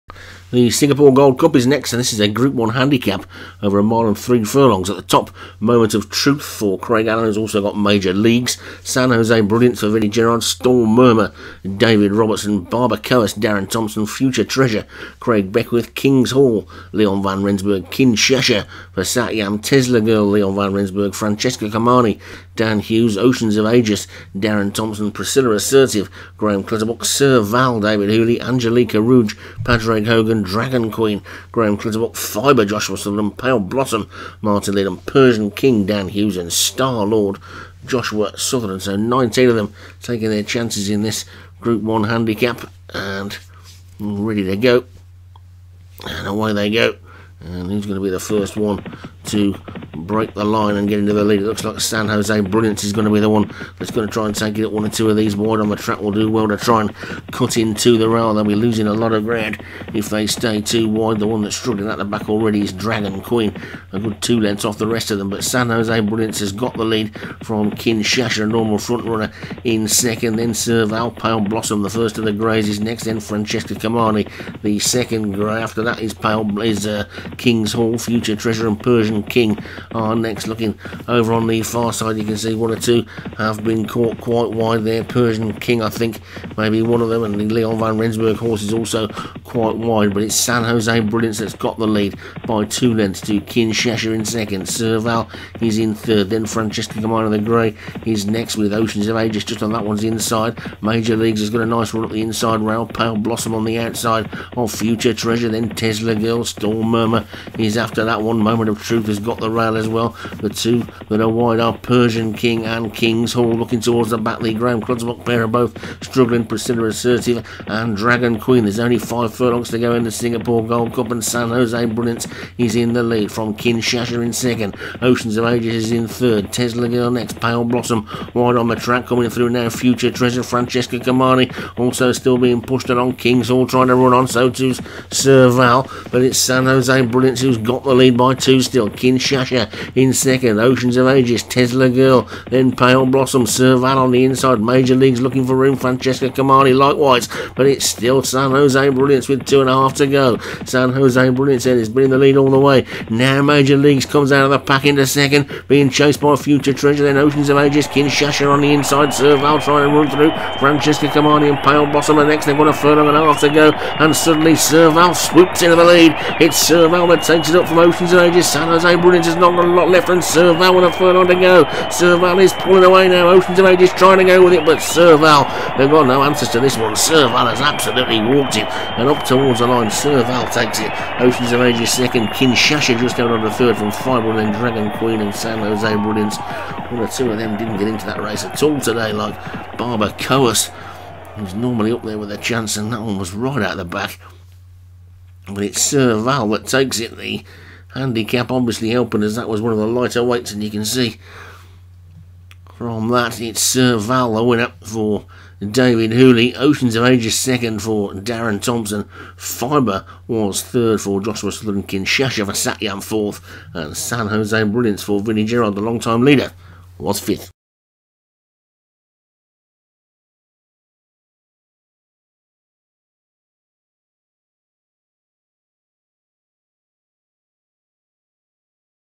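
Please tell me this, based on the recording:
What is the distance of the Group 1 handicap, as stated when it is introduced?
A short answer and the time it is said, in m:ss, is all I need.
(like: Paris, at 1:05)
A mile and three furlongs, at 0:03.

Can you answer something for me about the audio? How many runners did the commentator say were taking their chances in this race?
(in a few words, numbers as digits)
19.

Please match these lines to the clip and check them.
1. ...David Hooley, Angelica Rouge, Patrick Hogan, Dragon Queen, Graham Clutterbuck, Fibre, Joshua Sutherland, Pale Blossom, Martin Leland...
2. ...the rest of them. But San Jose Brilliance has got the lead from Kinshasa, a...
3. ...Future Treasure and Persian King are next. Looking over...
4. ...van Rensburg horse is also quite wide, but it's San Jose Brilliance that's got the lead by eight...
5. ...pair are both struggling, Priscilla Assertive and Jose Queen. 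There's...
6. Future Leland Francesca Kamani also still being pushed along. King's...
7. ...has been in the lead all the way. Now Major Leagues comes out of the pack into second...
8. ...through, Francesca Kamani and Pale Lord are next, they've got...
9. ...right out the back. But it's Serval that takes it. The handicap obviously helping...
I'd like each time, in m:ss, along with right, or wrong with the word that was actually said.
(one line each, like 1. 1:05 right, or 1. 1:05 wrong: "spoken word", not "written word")
1. 0:27 right
2. 1:04 right
3. 1:17 right
4. 1:27 wrong: "two", not "eight"
5. 1:55 wrong: "Dragon", not "Jose"
6. 2:09 wrong: "Treasure", not "Leland"
7. 2:31 right
8. 2:40 wrong: "Blossom", not "Lord"
9. 3:13 right.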